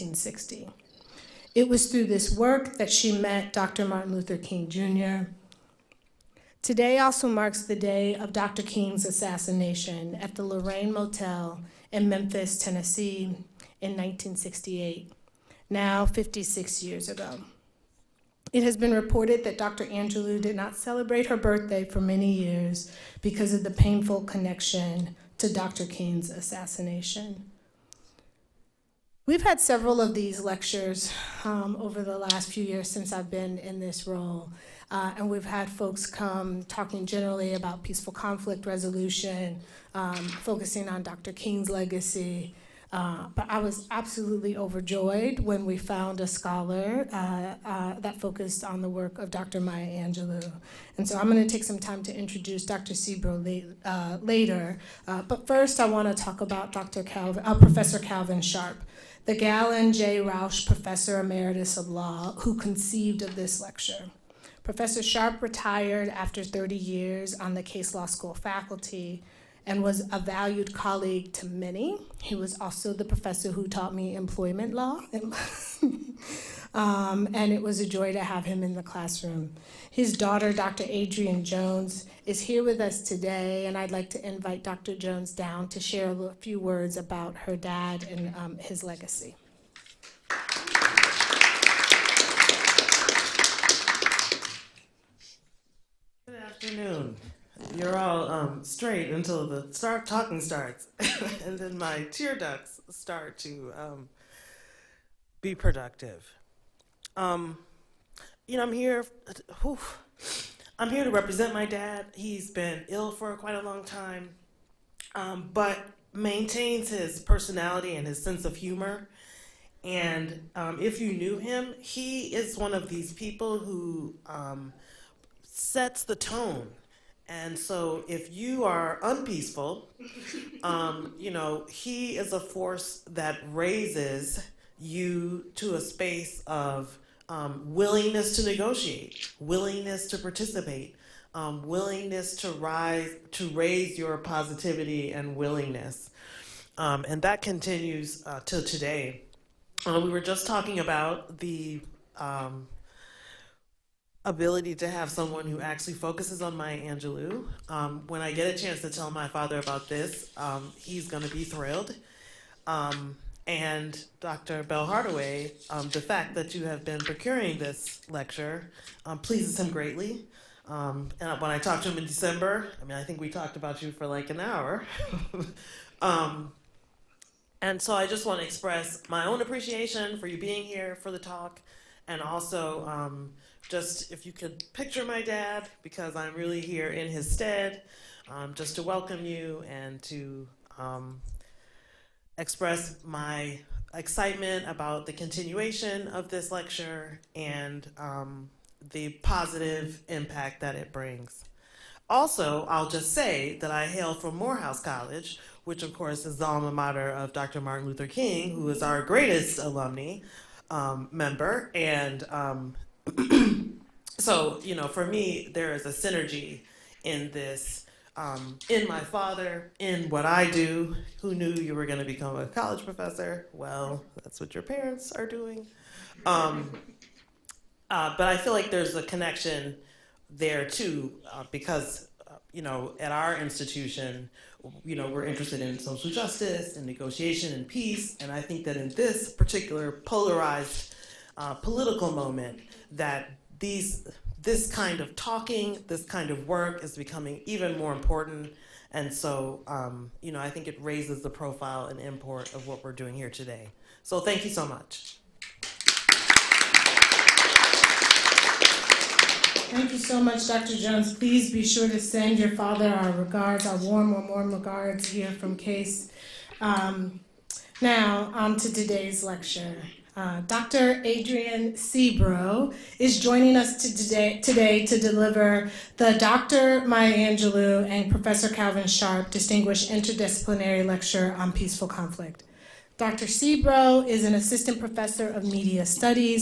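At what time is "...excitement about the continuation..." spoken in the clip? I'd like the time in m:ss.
3:13.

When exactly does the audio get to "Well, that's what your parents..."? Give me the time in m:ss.
3:43.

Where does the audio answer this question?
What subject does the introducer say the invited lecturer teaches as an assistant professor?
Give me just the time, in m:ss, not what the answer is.
4:45.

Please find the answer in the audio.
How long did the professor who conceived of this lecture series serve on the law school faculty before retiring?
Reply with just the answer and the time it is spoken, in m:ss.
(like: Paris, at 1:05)
30 years, at 1:06.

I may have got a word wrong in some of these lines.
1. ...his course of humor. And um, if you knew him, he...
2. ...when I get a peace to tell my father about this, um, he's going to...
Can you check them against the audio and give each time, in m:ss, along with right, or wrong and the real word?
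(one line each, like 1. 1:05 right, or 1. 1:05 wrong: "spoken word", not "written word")
1. 1:58 wrong: "sense", not "course"
2. 2:38 wrong: "chance", not "peace".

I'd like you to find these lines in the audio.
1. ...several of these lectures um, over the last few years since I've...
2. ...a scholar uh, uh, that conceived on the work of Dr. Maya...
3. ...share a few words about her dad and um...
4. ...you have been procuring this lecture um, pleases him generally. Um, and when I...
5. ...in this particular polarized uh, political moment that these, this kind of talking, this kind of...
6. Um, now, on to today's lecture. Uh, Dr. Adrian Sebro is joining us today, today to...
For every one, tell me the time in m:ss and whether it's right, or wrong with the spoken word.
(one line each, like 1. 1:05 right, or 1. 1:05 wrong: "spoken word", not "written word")
1. 0:29 right
2. 0:46 wrong: "focused", not "conceived"
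3. 1:25 right
4. 2:46 wrong: "greatly", not "generally"
5. 3:58 right
6. 4:26 right.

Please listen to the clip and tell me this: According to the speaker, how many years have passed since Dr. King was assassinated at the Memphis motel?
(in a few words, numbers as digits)
56.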